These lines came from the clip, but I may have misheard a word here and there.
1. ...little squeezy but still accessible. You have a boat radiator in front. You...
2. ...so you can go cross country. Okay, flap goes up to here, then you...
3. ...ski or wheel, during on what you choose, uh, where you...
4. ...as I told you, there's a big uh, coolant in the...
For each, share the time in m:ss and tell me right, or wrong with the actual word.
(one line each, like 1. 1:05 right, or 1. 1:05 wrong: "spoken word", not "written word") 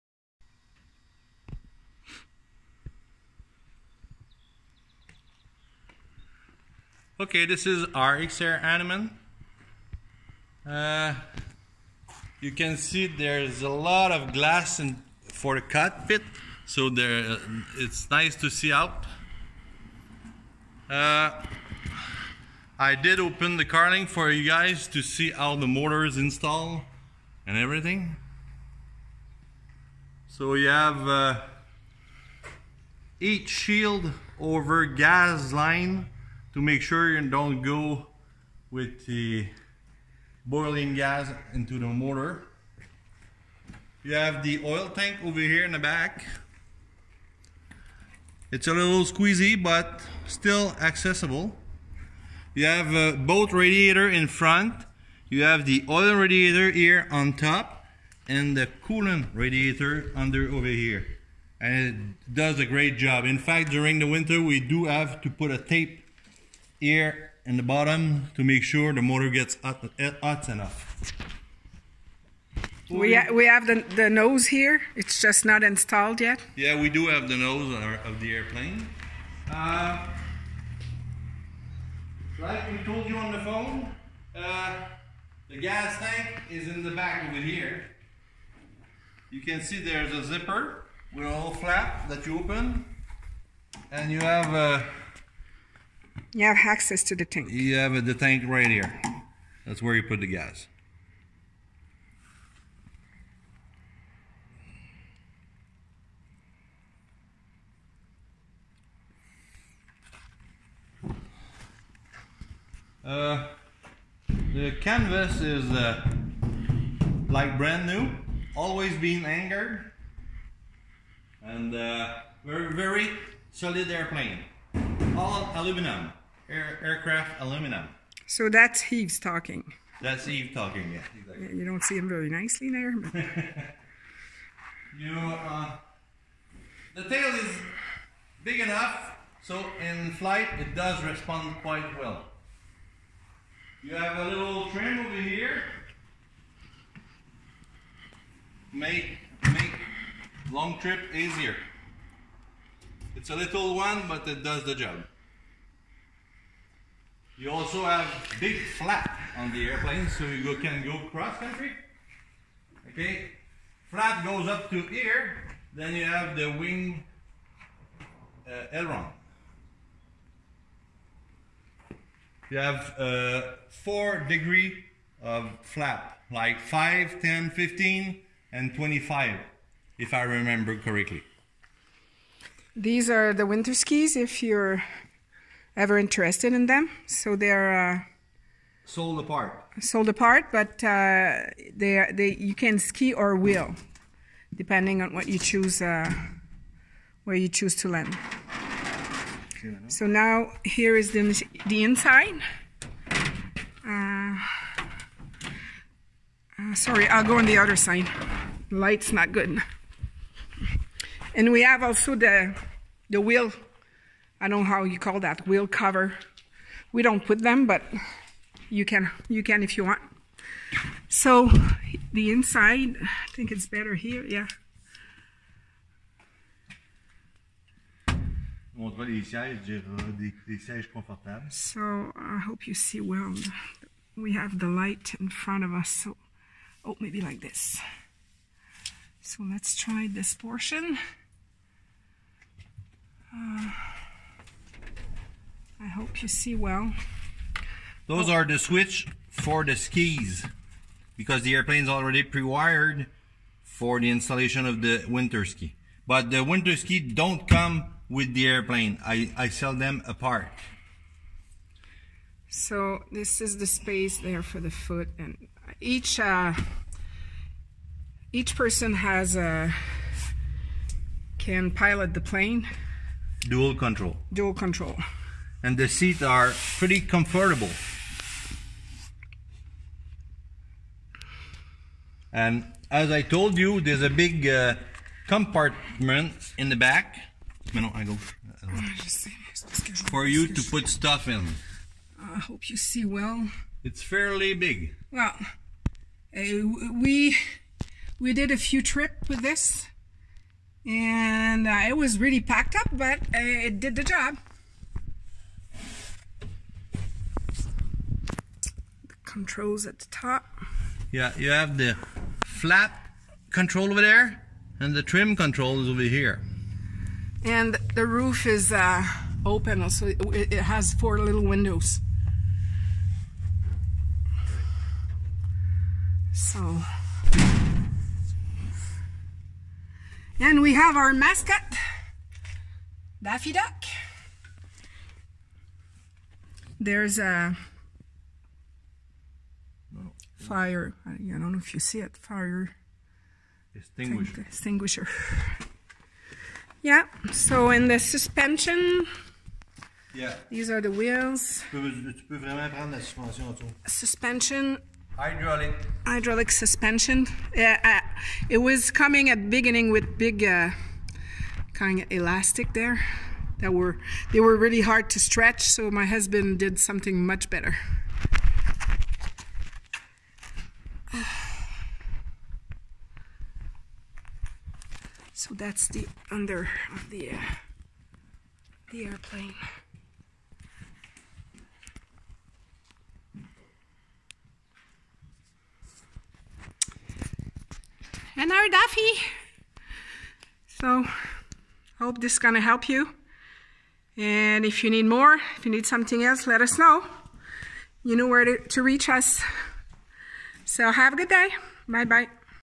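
1. 0:48 right
2. 2:40 right
3. 3:12 wrong: "depending", not "during"
4. 4:42 wrong: "compartment", not "coolant".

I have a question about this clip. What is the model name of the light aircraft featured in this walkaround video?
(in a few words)
X-Air Hanuman.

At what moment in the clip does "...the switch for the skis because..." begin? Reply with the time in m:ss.
4:08.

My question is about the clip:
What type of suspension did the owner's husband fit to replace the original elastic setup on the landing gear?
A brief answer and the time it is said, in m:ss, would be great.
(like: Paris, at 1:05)
Hydraulic, at 5:56.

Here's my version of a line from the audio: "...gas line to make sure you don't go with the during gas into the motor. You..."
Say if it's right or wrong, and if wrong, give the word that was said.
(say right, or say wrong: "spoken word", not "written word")
wrong: "boiling", not "during".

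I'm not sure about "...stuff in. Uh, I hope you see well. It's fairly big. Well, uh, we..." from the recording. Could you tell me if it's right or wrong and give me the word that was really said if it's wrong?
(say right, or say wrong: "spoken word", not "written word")
right.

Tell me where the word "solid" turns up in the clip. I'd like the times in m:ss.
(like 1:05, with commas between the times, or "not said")
2:03.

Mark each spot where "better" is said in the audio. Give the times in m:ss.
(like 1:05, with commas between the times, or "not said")
3:43, 6:07.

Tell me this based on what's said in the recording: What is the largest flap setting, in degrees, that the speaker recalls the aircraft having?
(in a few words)
25.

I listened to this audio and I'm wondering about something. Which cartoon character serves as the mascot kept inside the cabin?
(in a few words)
Daffy Duck.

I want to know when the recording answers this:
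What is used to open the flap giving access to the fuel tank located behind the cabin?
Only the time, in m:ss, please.
1:30.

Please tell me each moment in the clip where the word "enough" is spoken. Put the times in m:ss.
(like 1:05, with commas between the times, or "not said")
1:10, 2:18.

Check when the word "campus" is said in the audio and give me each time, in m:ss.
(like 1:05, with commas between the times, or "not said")
not said.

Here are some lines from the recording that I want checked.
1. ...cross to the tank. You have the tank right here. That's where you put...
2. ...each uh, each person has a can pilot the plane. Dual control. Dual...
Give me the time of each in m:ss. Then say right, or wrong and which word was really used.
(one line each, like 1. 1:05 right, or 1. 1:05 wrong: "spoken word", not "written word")
1. 1:36 wrong: "access", not "cross"
2. 4:25 right.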